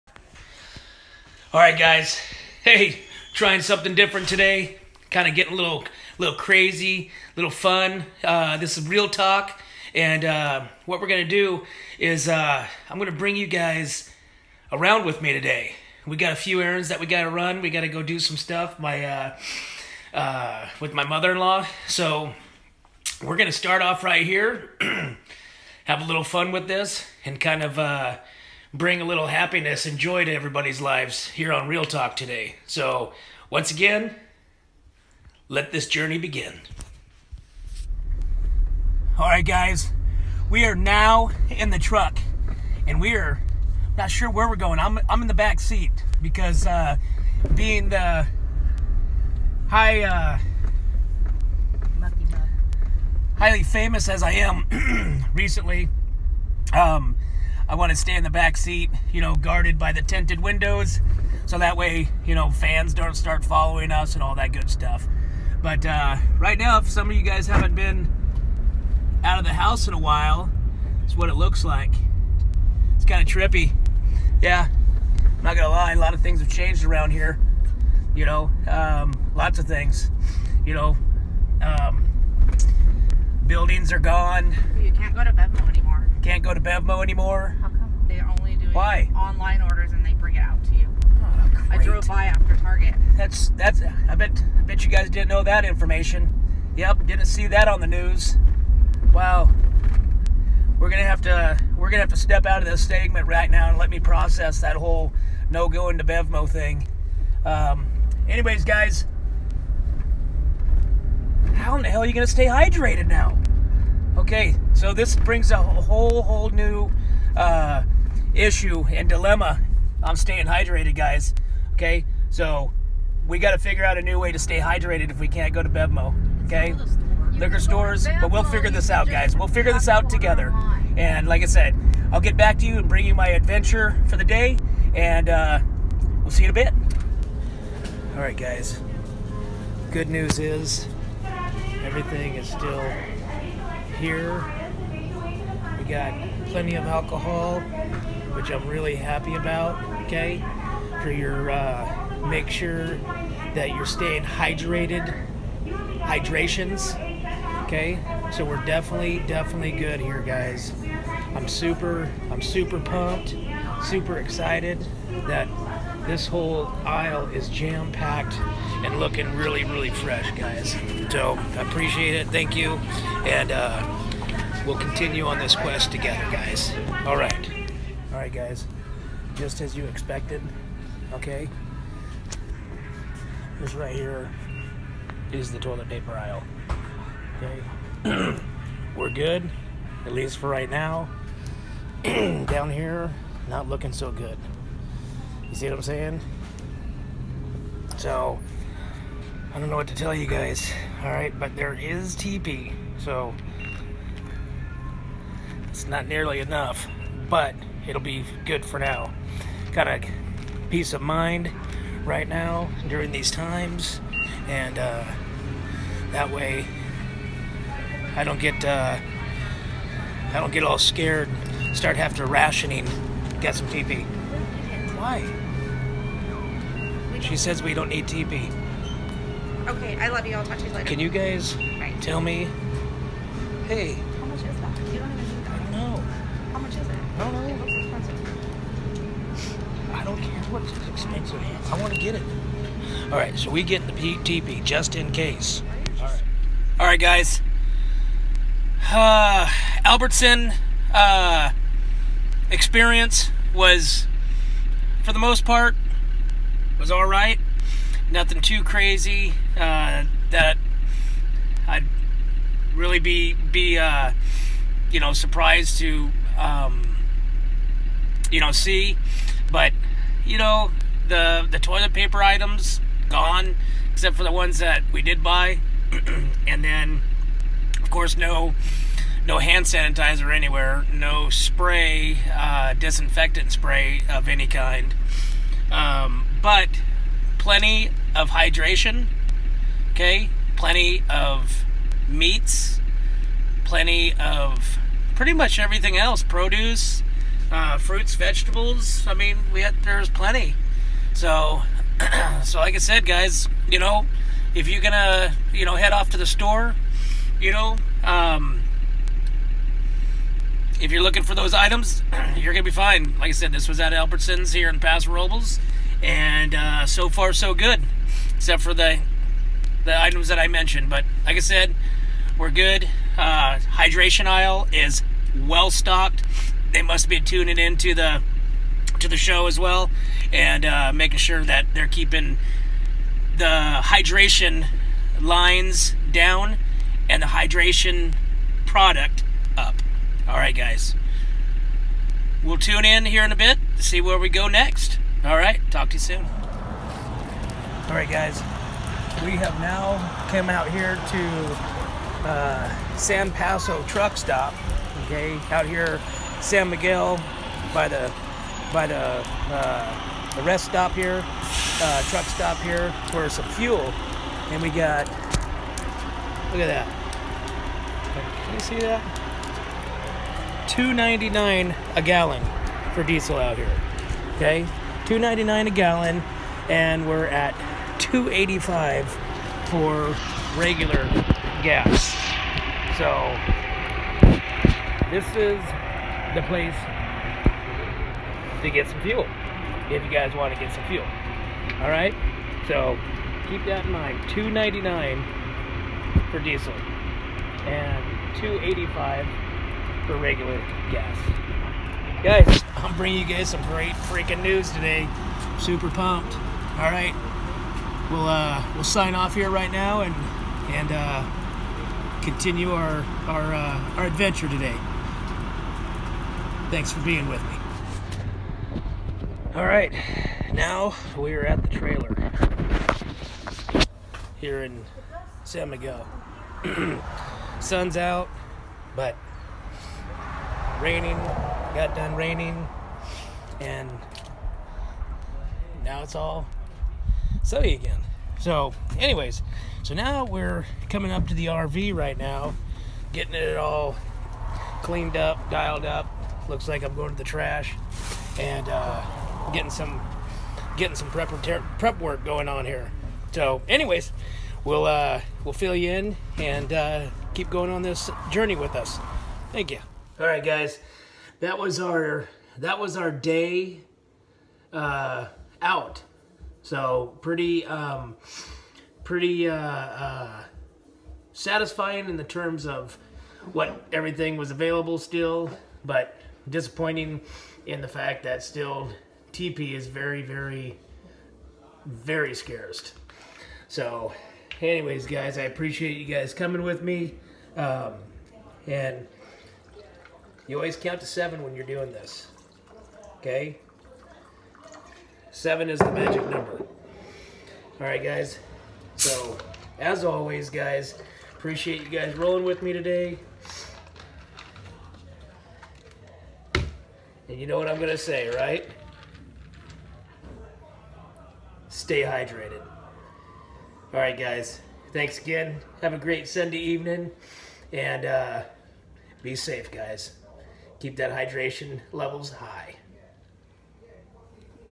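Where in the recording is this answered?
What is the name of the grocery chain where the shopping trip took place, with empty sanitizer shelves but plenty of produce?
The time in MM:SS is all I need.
05:13.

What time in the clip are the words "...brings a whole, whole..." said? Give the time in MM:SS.
01:55.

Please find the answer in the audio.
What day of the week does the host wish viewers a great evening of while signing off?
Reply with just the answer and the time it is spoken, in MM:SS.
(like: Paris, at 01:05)
Sunday, at 08:36.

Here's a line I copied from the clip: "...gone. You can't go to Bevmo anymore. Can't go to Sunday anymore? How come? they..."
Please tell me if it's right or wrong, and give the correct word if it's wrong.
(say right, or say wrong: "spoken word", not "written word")
wrong: "Bevmo", not "Sunday".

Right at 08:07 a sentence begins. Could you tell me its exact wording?
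Um, and you always count to seven when you're doing this.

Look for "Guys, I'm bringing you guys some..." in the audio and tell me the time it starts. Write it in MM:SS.
06:42.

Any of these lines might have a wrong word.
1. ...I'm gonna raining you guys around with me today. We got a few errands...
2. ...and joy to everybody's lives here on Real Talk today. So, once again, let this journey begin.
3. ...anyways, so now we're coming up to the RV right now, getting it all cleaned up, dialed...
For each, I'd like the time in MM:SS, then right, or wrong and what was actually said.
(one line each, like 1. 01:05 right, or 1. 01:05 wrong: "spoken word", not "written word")
1. 00:12 wrong: "bring", not "raining"
2. 00:29 right
3. 07:18 right.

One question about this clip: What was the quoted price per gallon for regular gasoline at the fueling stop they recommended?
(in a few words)
$2.85.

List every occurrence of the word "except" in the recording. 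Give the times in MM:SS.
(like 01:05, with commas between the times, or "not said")
04:33, 05:18.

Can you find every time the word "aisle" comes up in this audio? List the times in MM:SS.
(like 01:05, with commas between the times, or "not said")
02:46, 03:06, 05:24.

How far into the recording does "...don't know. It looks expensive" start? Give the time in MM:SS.
03:57.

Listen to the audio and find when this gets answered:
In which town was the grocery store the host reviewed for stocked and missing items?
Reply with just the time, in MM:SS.
05:14.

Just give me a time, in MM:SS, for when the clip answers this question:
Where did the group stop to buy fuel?
05:52.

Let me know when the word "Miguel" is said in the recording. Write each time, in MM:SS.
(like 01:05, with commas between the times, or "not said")
05:56, 07:05.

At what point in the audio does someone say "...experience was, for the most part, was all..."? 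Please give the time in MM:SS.
04:12.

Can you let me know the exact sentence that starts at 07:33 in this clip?
So, anyways, we'll uh, we'll fill you in and uh, keep going on this journey with us.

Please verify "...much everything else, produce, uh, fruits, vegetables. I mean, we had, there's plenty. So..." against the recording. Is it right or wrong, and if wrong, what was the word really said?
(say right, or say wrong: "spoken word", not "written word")
right.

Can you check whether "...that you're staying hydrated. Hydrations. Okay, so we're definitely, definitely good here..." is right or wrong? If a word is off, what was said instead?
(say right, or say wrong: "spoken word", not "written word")
right.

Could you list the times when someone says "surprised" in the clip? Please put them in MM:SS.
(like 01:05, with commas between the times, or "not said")
04:25.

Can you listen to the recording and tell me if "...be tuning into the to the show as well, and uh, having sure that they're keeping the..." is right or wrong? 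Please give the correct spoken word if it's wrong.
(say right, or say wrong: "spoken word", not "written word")
wrong: "making", not "having".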